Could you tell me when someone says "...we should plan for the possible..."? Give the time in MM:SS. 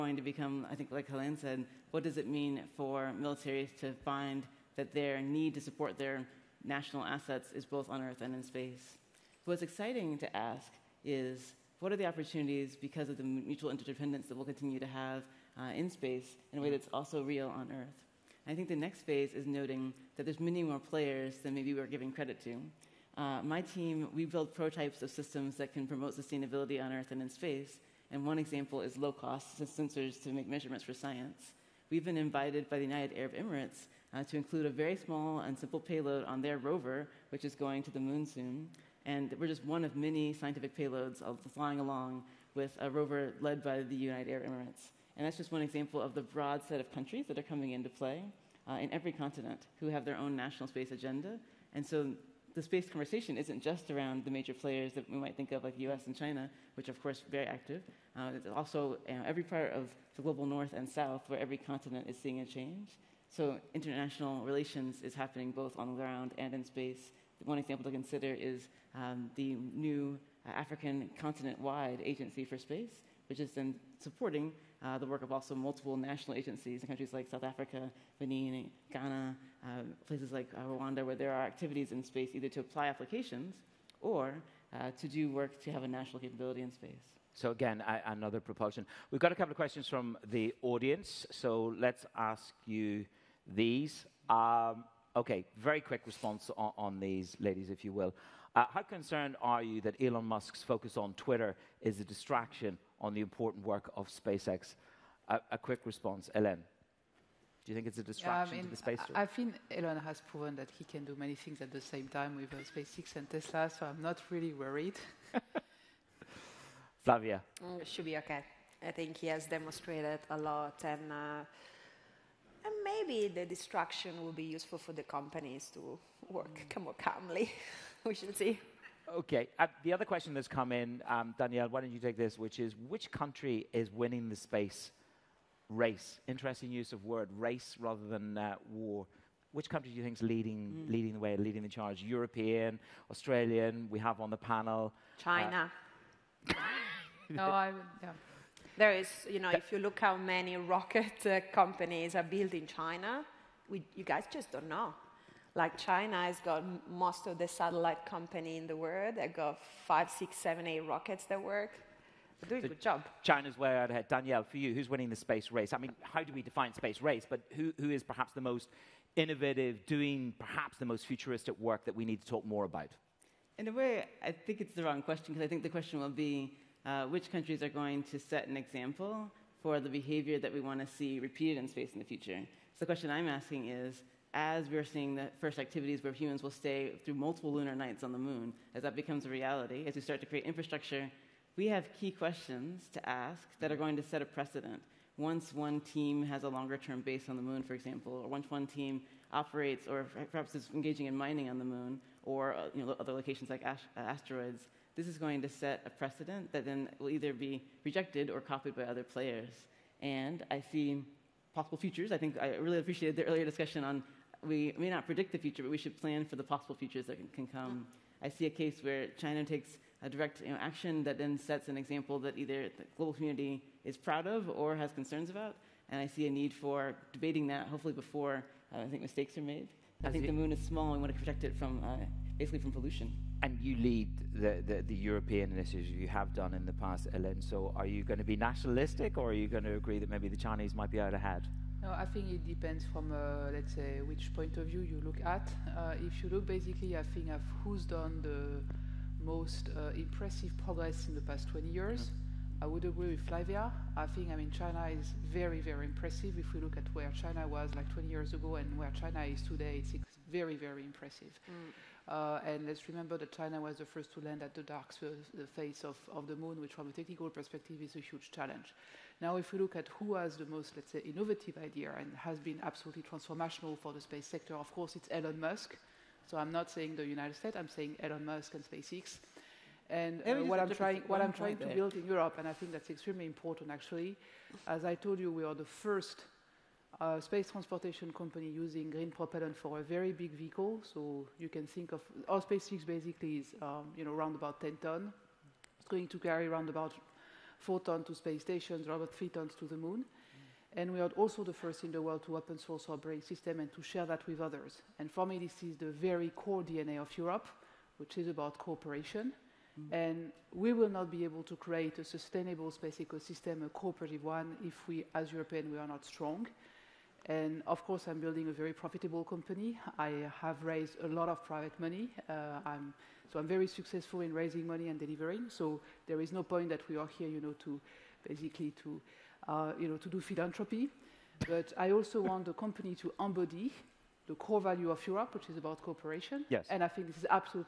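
03:35.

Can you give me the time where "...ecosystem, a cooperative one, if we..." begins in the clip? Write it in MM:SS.
05:12.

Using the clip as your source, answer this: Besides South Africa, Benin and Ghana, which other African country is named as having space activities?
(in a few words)
Rwanda.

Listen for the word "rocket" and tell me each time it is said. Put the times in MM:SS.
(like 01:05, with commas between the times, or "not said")
02:30, 02:40.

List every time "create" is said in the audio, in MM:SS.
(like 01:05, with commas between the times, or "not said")
03:10, 05:11.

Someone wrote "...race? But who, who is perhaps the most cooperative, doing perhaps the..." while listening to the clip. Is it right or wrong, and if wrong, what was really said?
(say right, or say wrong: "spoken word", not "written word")
wrong: "innovative", not "cooperative".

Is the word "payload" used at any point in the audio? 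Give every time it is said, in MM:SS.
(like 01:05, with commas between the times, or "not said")
00:35, 00:40.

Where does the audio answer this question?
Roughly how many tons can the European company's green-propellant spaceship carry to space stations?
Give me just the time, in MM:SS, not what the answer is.
04:57.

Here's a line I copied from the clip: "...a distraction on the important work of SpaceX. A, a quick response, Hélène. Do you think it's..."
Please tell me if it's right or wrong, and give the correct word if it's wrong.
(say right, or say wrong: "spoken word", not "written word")
right.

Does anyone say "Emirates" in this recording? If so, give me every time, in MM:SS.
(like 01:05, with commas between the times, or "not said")
00:33, 00:44.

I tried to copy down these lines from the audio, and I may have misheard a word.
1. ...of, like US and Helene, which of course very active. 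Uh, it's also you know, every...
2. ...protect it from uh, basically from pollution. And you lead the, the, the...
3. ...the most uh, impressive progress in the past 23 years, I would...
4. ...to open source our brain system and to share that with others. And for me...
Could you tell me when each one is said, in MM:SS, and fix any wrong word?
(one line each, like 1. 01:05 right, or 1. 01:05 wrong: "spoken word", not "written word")
1. 00:55 wrong: "China", not "Helene"
2. 03:51 right
3. 04:08 wrong: "20", not "23"
4. 05:02 right.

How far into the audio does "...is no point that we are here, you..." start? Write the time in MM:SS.
05:26.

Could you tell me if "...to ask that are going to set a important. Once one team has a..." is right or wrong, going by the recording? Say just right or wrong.
wrong.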